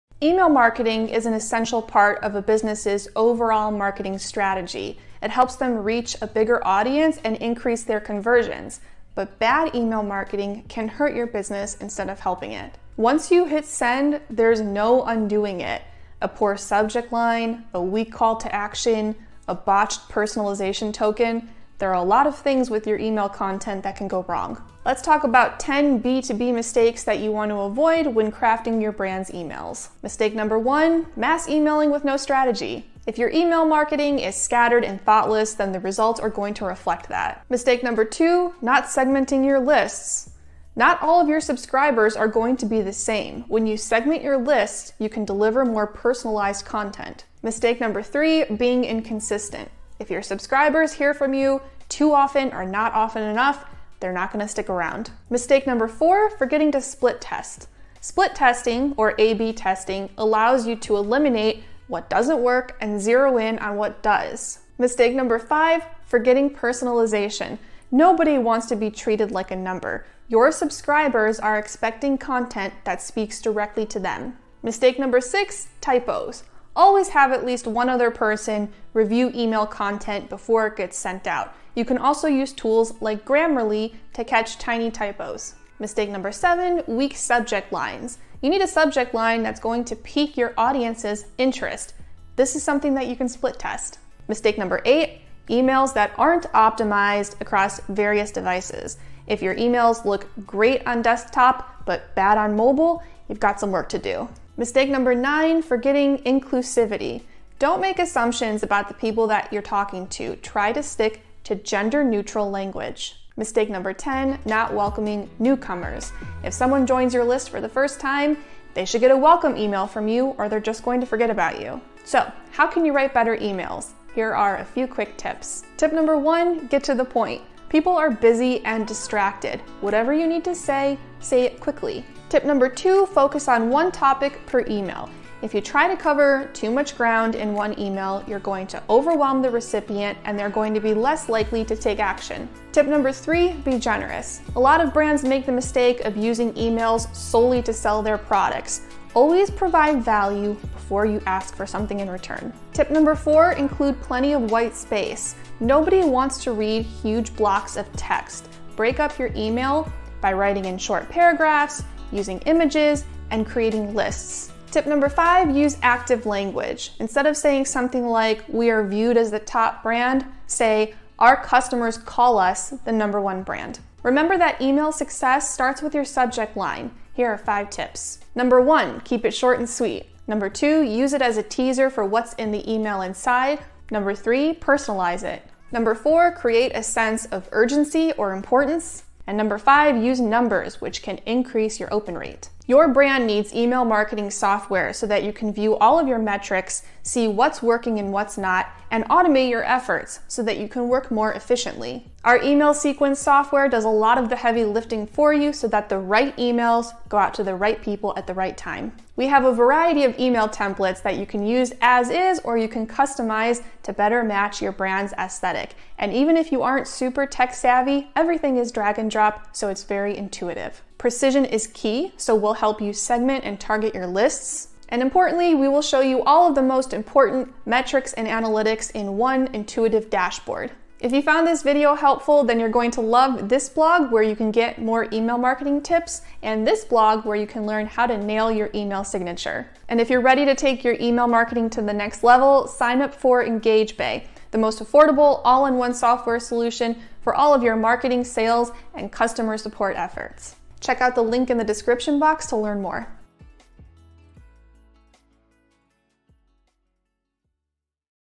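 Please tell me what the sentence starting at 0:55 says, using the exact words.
Mistake number four, forgetting to split test.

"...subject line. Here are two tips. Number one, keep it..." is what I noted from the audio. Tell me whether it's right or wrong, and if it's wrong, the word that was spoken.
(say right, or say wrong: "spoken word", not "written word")
wrong: "five", not "two".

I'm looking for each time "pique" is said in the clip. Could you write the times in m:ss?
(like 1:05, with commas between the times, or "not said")
1:29.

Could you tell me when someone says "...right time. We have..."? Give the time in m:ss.
3:28.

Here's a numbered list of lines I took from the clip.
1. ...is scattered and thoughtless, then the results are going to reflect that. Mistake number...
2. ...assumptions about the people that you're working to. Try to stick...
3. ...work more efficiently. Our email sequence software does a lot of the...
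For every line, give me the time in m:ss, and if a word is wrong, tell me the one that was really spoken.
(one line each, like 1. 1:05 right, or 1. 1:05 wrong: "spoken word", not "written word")
1. 0:34 right
2. 1:47 wrong: "talking", not "working"
3. 3:20 right.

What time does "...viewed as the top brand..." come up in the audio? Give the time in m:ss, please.
2:48.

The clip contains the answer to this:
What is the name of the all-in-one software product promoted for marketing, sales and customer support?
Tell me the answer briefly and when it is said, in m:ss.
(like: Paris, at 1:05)
EngageBay, at 4:03.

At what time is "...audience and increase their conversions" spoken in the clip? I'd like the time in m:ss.
0:06.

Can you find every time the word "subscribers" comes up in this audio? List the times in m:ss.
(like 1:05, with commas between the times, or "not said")
0:41, 0:50, 1:10.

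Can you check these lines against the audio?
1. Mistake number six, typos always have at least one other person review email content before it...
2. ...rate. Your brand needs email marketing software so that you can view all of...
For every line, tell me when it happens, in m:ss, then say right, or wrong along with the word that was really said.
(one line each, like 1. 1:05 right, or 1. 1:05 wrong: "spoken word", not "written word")
1. 1:14 right
2. 3:12 right.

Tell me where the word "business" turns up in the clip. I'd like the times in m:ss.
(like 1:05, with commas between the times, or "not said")
0:02, 0:11.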